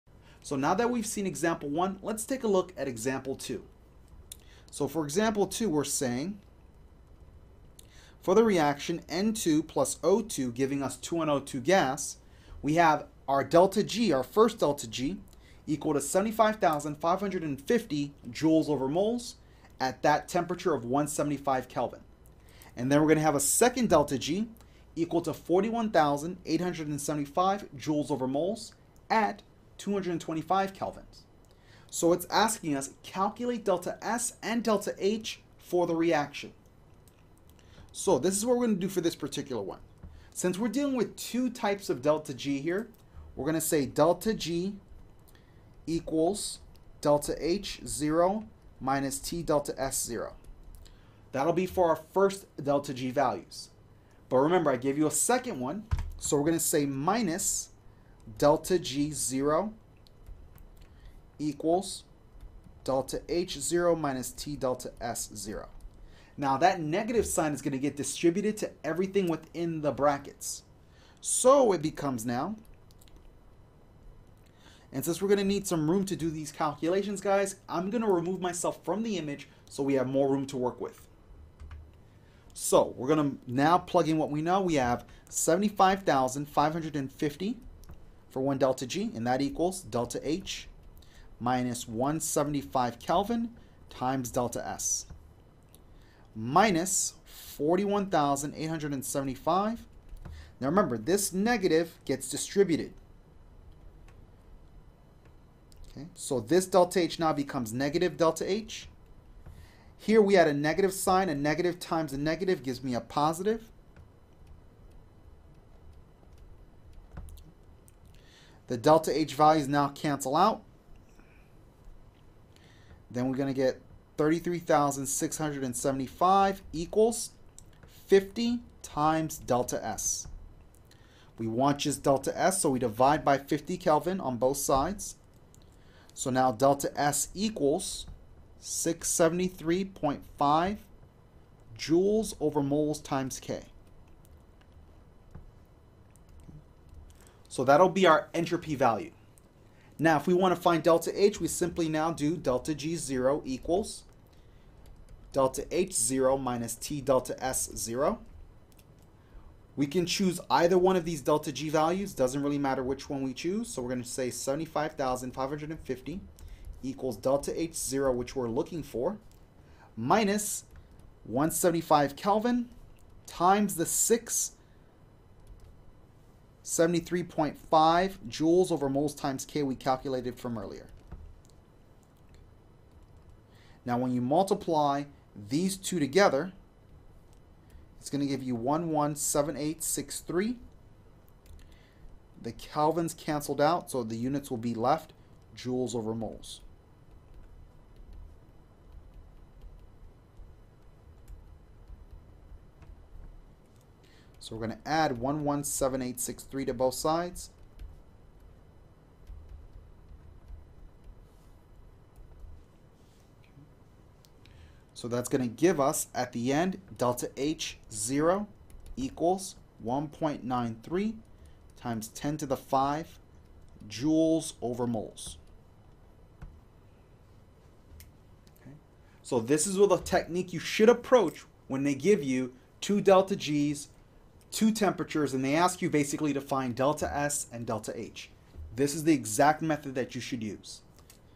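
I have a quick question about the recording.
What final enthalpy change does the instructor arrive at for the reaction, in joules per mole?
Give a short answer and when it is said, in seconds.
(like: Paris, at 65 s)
1.93 times 10 to the 5, at 219 s.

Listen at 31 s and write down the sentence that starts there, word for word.
So it's asking us calculate delta S and delta H for the reaction.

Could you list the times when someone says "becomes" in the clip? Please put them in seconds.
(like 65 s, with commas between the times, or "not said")
71 s, 107 s.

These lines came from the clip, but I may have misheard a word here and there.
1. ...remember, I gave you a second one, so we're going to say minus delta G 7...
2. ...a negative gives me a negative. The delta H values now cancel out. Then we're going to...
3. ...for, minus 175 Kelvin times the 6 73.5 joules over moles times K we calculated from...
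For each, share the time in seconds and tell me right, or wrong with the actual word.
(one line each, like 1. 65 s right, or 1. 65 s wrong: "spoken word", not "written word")
1. 54 s wrong: "0", not "7"
2. 112 s wrong: "positive", not "negative"
3. 168 s right.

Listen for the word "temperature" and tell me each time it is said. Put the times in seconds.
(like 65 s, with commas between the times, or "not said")
20 s, 234 s.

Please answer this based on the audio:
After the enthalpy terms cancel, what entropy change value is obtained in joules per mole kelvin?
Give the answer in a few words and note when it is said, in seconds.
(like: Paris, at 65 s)
673.5, at 138 s.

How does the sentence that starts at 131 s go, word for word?
We want just delta S, so we divide by 50 Kelvin on both sides.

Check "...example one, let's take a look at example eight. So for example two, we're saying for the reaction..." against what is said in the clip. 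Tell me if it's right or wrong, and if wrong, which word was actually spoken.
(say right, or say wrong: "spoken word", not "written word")
wrong: "two", not "eight".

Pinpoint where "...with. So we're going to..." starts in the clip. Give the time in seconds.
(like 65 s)
80 s.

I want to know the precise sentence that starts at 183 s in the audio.
Now when you multiply these two together, it's going to give you 117863.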